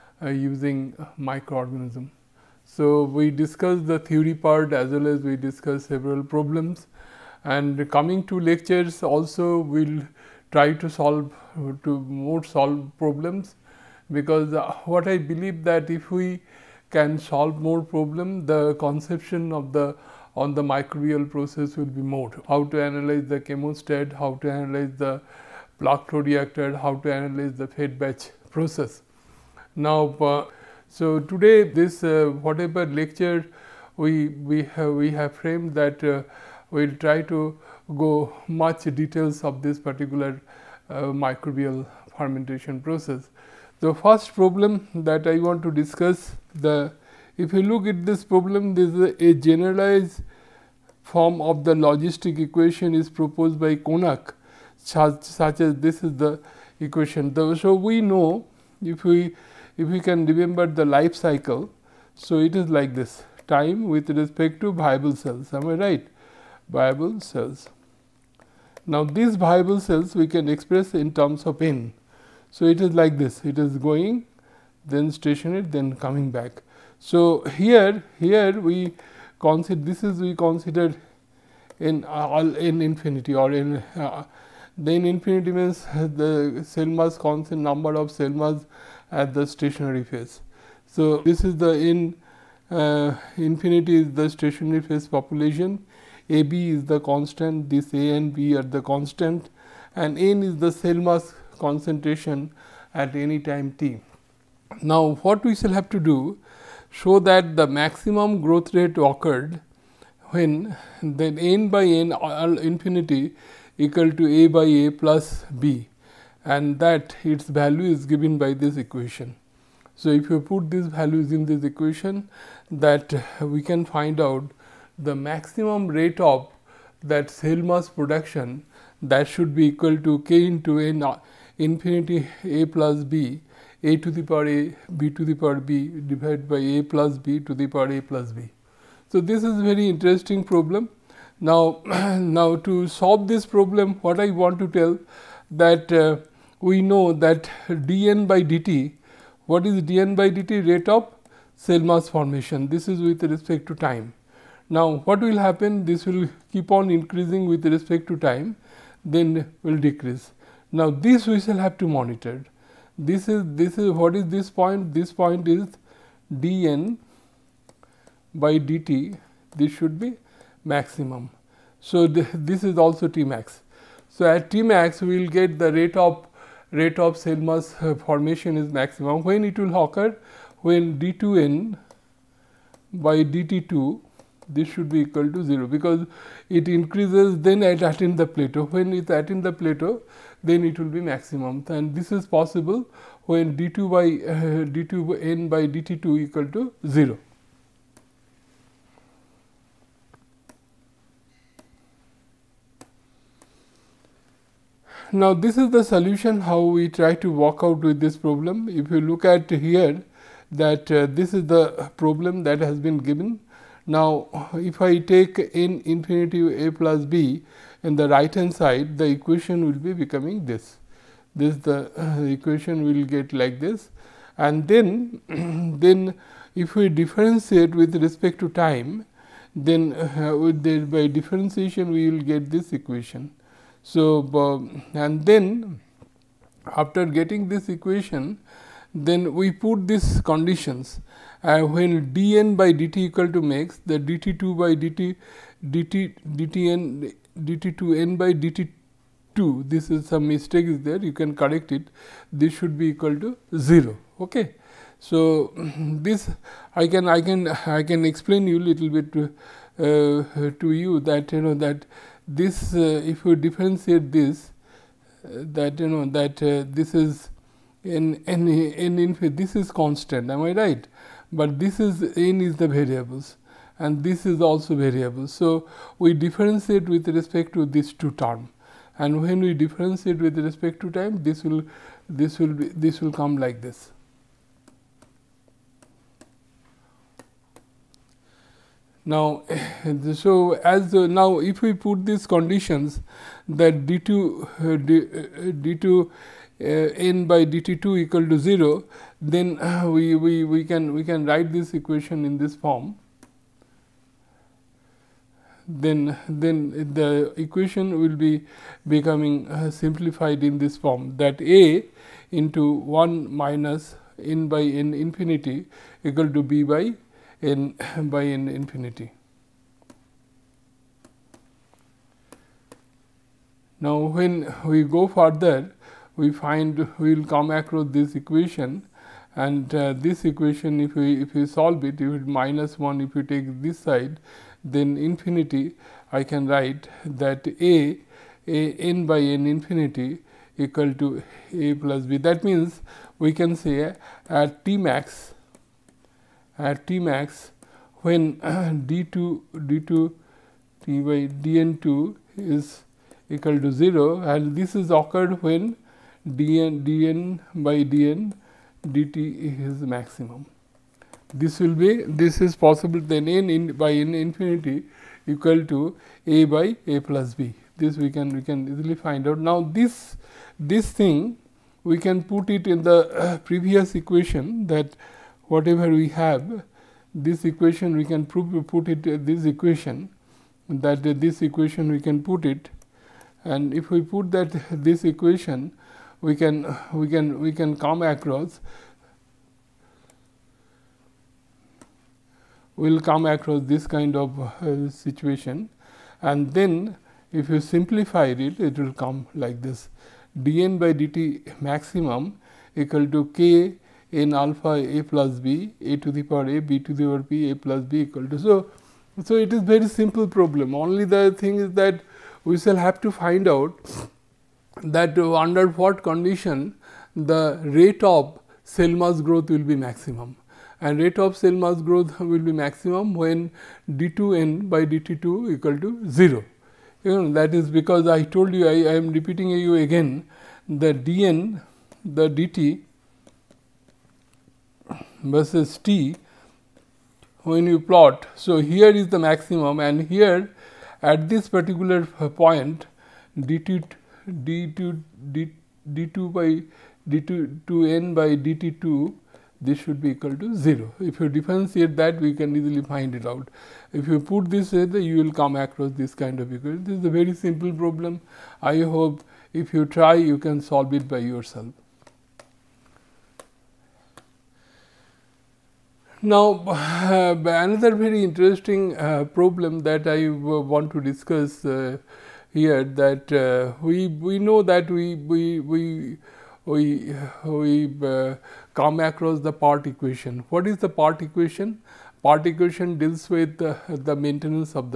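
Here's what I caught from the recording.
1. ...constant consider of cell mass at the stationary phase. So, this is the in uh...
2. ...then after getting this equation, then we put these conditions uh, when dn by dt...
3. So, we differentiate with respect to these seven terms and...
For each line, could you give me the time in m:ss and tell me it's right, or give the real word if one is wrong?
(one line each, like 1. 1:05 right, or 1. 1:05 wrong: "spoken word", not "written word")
1. 1:27 wrong: "number", not "consider"
2. 3:55 right
3. 4:35 wrong: "two", not "seven".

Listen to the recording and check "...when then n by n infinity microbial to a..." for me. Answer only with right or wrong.
wrong.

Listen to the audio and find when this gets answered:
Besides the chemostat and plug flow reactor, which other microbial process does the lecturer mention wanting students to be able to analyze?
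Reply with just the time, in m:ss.
0:27.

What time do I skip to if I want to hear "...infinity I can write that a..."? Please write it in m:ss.
5:34.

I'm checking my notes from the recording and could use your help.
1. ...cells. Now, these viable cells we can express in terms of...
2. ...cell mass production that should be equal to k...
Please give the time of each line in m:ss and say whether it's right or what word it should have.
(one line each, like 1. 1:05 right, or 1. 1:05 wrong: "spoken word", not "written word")
1. 1:07 right
2. 2:07 right.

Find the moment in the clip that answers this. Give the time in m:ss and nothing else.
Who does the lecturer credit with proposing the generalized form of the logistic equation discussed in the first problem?
0:53.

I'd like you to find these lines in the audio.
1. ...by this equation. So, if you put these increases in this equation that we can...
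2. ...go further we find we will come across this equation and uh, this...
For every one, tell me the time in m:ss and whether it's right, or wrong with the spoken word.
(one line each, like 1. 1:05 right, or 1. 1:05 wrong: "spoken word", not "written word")
1. 1:58 wrong: "values", not "increases"
2. 5:24 right.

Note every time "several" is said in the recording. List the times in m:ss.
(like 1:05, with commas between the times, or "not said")
0:05.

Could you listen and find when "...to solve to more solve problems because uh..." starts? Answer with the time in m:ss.
0:10.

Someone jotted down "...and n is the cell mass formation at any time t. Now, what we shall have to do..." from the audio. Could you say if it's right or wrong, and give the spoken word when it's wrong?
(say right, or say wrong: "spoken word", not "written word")
wrong: "concentration", not "formation".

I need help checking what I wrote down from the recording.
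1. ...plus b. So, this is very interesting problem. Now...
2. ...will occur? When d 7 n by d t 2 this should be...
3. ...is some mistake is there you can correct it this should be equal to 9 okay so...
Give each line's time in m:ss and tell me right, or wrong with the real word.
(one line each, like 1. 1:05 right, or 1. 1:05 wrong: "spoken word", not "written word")
1. 2:18 right
2. 2:59 wrong: "2", not "7"
3. 4:09 wrong: "0", not "9".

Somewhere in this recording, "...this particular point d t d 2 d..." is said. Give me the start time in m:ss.
7:21.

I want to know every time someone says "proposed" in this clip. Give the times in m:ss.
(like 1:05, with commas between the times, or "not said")
0:53.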